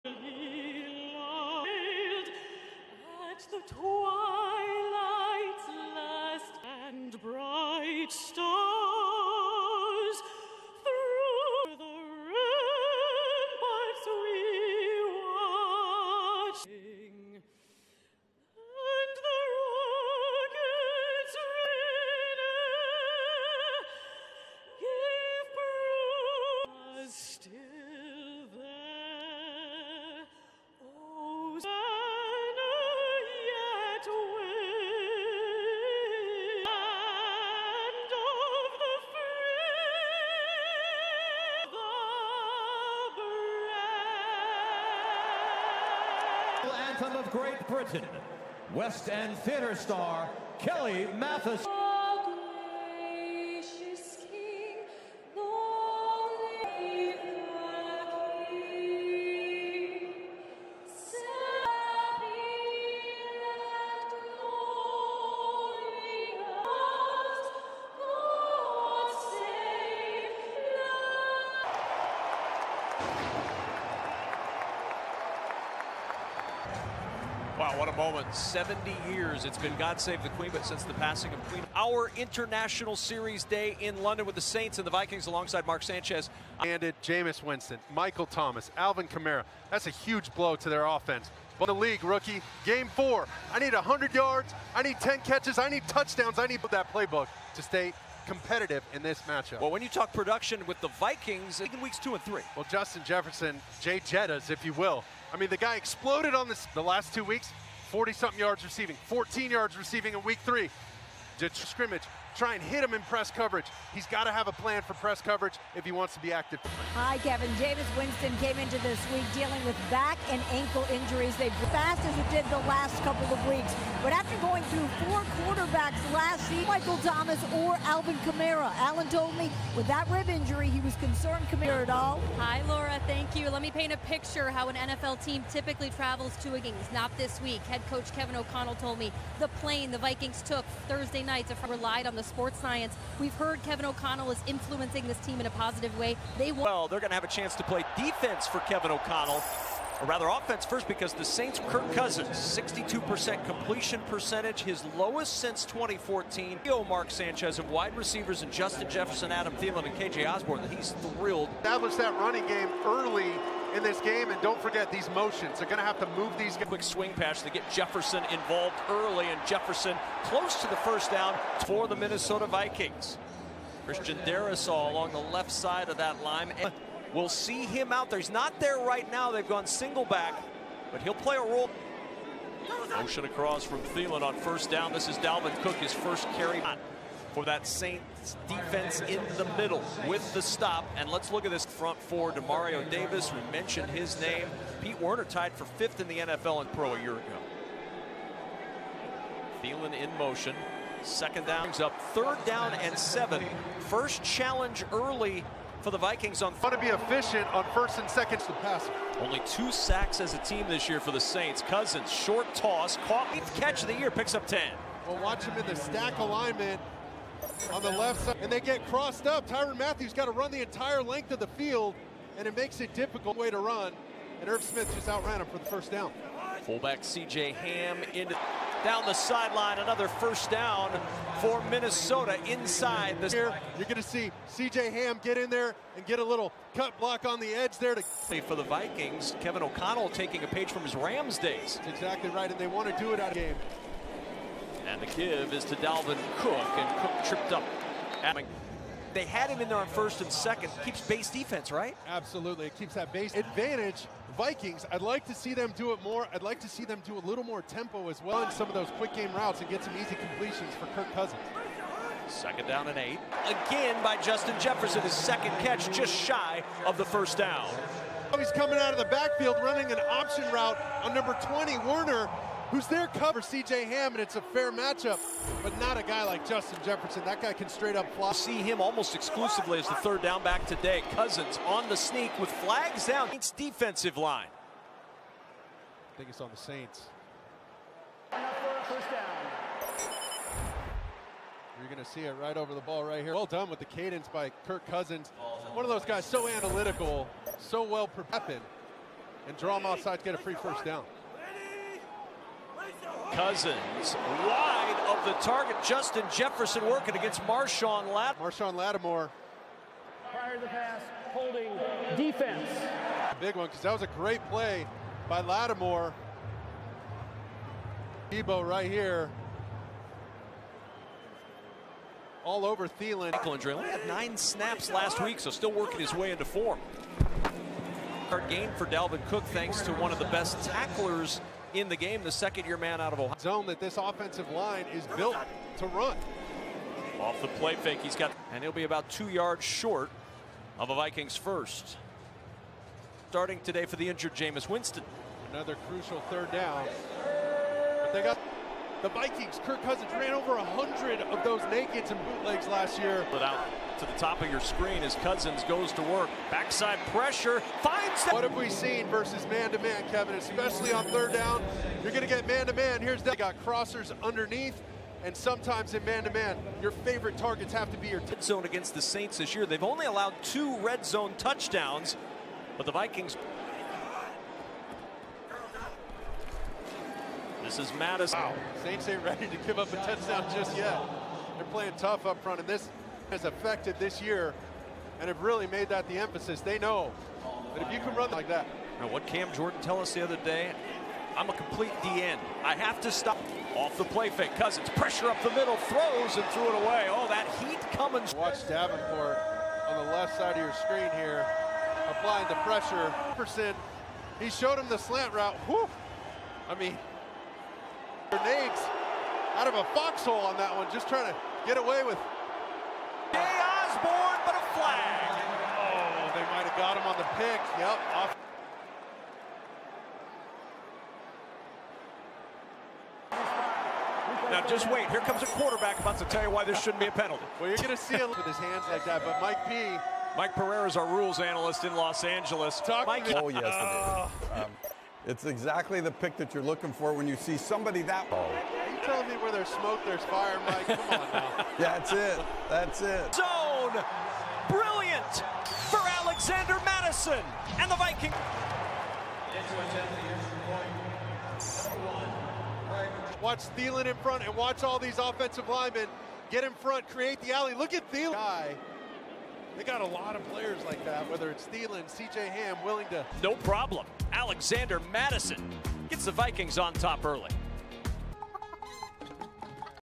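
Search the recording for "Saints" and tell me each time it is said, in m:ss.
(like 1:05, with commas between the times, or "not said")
1:24, 2:31, 3:07, 3:31, 4:46, 6:09, 6:18.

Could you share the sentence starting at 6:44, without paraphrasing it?
He showed him the slant route.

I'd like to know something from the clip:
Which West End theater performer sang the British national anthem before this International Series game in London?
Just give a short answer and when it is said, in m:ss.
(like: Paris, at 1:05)
Kelly Mathis, at 0:50.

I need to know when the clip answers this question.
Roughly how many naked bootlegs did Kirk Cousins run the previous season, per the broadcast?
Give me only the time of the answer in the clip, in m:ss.
5:50.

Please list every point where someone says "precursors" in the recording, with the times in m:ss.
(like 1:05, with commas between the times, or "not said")
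not said.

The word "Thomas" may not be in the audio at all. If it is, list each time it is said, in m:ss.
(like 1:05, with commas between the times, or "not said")
1:28, 2:06.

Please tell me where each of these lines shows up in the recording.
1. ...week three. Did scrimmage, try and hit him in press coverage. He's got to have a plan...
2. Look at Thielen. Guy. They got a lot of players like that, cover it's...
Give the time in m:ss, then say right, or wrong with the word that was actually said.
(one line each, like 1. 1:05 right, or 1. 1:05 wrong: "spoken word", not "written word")
1. 1:50 right
2. 7:37 wrong: "whether", not "cover".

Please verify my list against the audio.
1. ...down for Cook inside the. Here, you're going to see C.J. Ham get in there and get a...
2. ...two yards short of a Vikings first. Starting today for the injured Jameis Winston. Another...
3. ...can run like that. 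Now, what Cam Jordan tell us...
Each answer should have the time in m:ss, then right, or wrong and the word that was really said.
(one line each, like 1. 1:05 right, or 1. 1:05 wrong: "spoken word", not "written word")
1. 3:50 wrong: "Minnesota", not "Cook"
2. 5:39 right
3. 6:27 right.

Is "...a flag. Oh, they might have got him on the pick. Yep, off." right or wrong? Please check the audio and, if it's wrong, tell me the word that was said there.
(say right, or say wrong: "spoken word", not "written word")
right.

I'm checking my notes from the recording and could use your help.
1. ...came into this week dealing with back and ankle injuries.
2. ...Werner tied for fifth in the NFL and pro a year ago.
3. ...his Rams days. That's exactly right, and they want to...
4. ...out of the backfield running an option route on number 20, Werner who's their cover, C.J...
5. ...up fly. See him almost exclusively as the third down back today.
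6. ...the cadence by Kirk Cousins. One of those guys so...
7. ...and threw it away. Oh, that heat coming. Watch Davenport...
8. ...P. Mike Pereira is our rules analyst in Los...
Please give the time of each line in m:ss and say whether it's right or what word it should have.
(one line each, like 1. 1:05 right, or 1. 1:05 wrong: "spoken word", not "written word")
1. 1:58 right
2. 3:15 right
3. 4:00 right
4. 4:28 right
5. 4:37 right
6. 4:53 right
7. 6:36 right
8. 7:09 right.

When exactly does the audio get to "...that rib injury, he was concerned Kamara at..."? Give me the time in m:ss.
2:09.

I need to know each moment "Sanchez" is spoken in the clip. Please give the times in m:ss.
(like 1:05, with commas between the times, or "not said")
1:25, 2:37.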